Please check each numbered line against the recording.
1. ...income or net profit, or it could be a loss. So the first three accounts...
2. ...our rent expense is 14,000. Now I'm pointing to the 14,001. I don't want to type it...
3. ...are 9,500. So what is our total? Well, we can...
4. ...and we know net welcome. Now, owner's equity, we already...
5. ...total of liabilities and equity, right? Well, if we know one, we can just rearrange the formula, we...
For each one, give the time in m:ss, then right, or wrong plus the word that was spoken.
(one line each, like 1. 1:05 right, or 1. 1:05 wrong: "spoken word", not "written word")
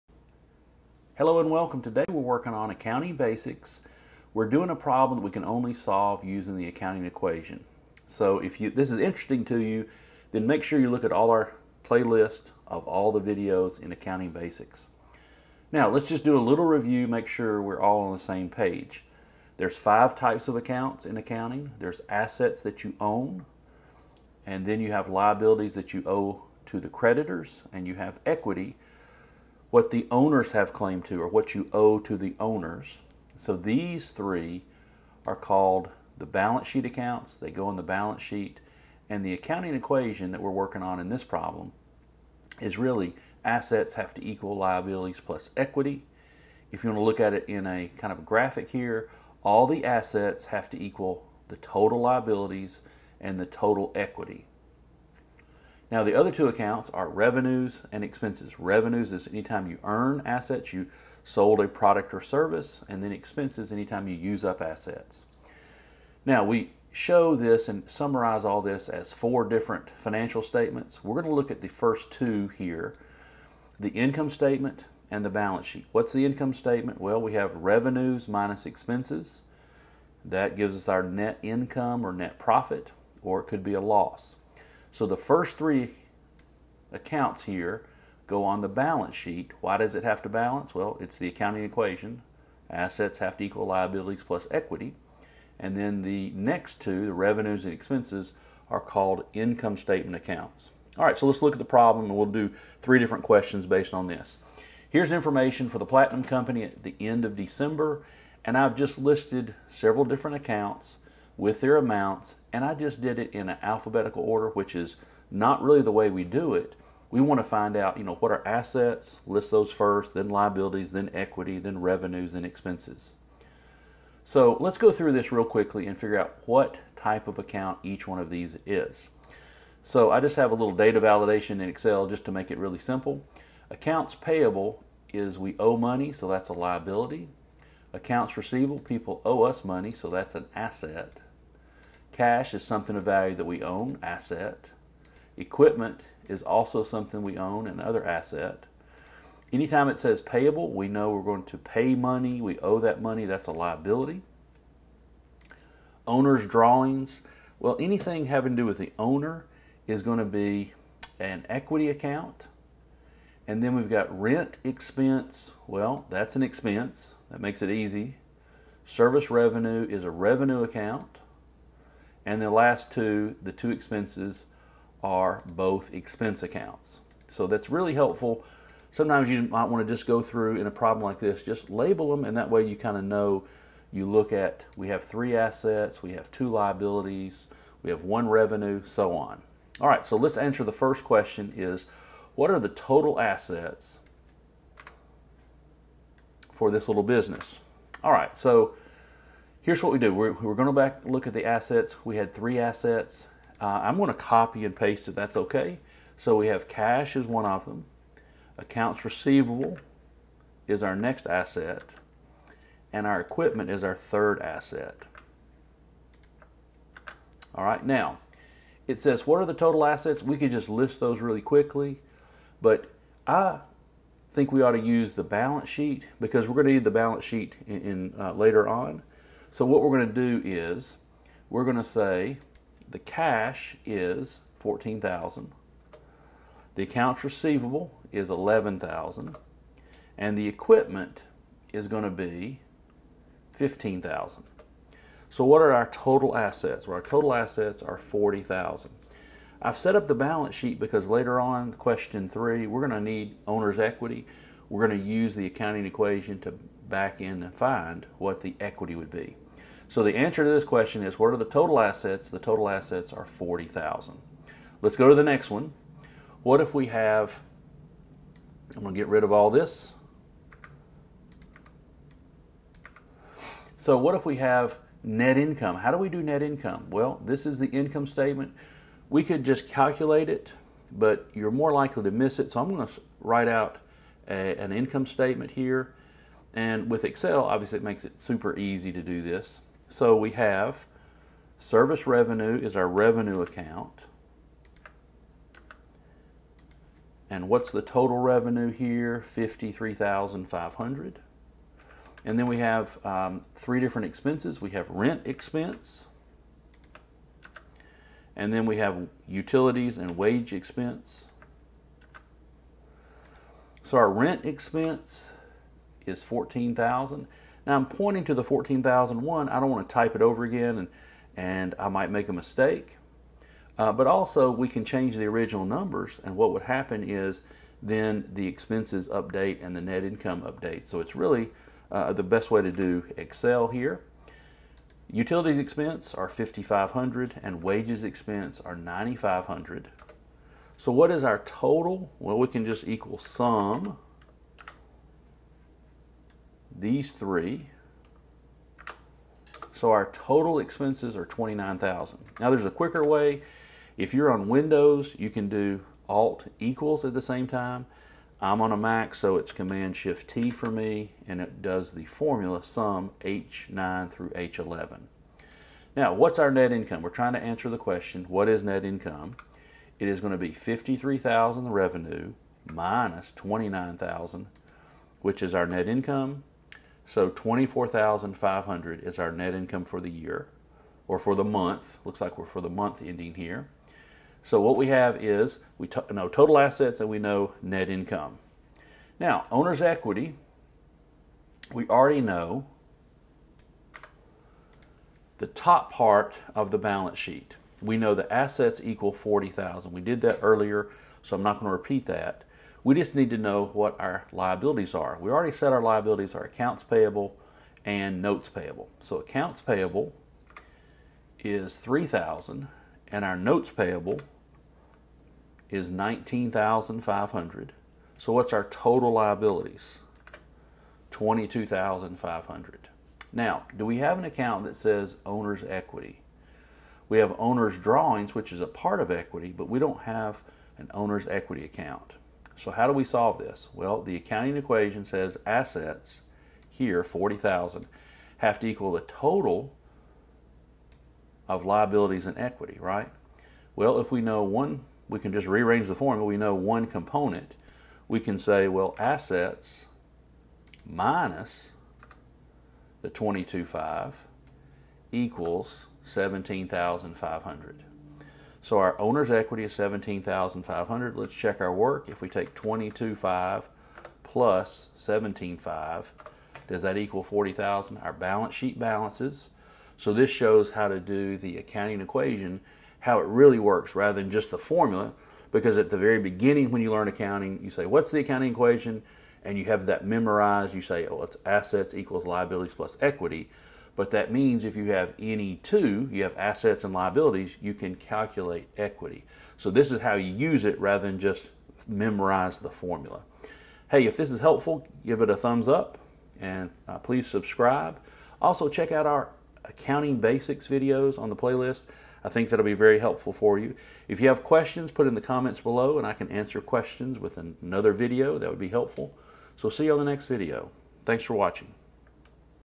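1. 1:21 right
2. 5:13 right
3. 5:38 right
4. 6:27 wrong: "income", not "welcome"
5. 7:19 right.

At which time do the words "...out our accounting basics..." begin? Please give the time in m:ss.
8:18.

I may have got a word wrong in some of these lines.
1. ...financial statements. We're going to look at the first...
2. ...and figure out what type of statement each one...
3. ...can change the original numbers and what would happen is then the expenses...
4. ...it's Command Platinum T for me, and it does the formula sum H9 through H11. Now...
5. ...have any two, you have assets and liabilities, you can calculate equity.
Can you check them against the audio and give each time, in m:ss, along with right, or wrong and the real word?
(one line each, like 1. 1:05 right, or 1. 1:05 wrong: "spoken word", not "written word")
1. 1:09 right
2. 2:05 wrong: "account", not "statement"
3. 5:24 right
4. 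5:59 wrong: "Shift", not "Platinum"
5. 8:04 right.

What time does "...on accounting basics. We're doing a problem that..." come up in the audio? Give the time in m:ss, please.
0:02.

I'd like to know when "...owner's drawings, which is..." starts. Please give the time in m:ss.
7:07.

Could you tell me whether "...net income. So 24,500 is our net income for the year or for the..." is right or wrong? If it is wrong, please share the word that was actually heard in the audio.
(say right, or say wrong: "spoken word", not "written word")
right.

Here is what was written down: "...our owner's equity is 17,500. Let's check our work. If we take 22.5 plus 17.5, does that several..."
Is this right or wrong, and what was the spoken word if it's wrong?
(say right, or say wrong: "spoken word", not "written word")
wrong: "equal", not "several".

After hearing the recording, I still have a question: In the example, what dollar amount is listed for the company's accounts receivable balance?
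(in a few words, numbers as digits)
11,000.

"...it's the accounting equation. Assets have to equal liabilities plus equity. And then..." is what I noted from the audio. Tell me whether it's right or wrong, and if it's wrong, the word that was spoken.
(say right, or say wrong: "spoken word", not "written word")
right.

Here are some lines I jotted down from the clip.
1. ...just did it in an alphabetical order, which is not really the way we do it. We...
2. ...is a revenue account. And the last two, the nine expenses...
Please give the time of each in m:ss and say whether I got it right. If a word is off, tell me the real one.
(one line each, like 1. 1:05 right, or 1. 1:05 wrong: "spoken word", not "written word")
1. 1:52 right
2. 2:49 wrong: "two", not "nine".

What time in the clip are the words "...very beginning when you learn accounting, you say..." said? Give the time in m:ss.
7:55.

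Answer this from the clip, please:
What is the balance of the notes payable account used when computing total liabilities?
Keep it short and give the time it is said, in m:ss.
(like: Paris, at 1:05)
19,500, at 6:55.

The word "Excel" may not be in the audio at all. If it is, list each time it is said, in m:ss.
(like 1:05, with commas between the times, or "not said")
2:11, 4:47, 5:33.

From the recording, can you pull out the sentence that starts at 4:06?
Well, our total assets are 40,000.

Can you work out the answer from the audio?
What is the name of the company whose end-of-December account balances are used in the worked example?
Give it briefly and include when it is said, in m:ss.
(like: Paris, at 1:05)
Platinum Company, at 1:45.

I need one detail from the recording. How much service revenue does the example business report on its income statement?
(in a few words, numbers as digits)
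53,500.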